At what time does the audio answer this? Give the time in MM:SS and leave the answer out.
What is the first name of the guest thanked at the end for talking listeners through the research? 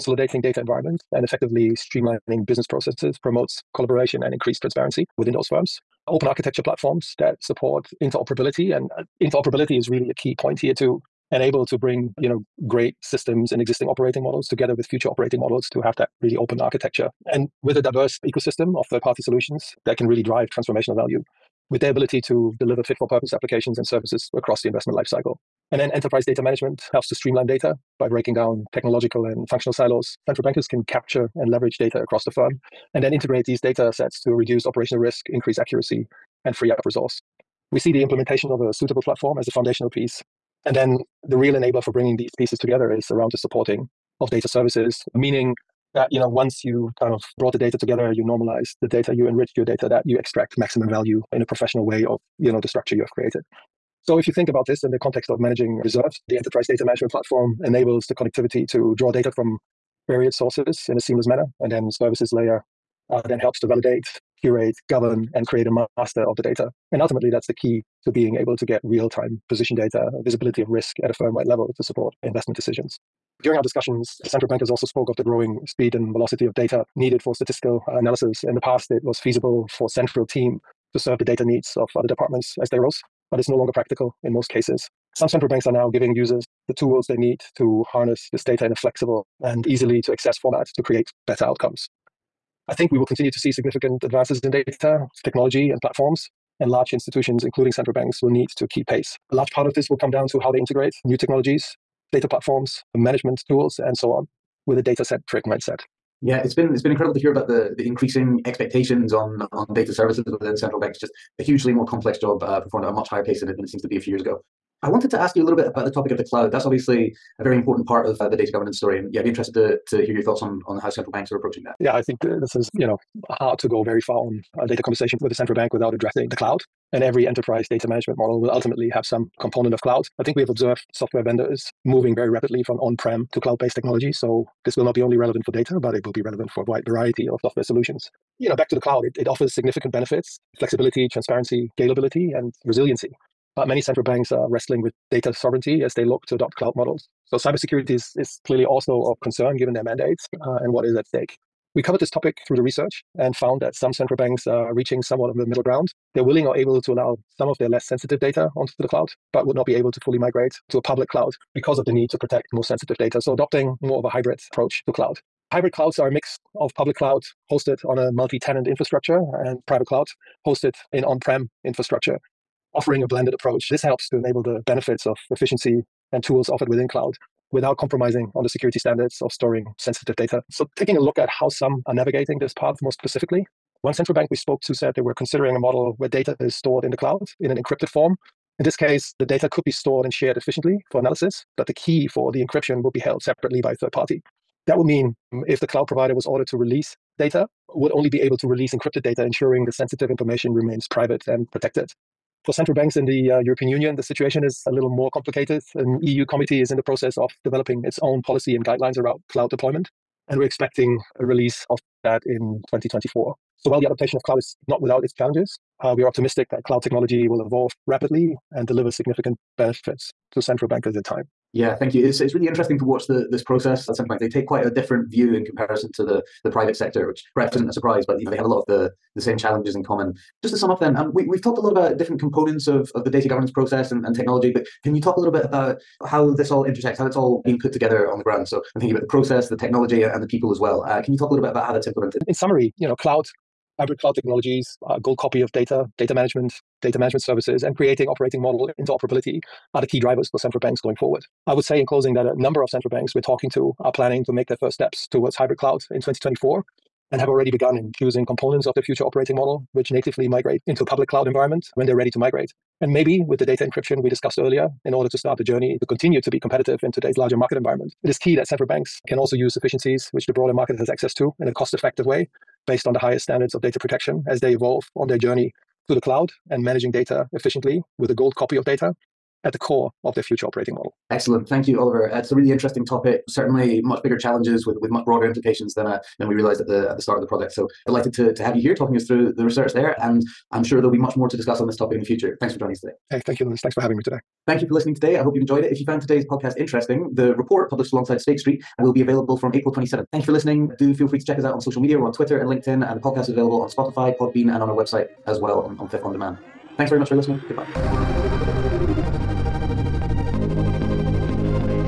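04:41.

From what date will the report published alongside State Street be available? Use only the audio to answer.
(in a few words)
April 27th.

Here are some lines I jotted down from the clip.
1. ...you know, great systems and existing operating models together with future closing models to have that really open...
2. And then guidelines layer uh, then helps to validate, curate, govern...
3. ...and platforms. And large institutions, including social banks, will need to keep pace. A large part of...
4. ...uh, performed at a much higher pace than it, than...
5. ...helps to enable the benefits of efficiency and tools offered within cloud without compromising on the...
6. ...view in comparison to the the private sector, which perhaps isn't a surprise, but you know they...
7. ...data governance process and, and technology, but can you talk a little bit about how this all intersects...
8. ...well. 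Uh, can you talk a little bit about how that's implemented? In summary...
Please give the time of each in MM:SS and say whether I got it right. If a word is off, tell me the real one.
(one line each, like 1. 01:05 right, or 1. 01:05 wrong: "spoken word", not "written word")
1. 00:12 wrong: "operating", not "closing"
2. 01:01 wrong: "services", not "guidelines"
3. 01:35 wrong: "central", not "social"
4. 01:52 right
5. 02:53 right
6. 03:45 right
7. 03:53 right
8. 04:00 right.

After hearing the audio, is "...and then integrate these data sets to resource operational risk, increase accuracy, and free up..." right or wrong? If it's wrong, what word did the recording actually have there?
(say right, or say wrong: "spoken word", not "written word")
wrong: "reduce", not "resource".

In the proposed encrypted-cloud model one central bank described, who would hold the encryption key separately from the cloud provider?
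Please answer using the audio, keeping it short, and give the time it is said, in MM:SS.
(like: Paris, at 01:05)
a third party, at 03:13.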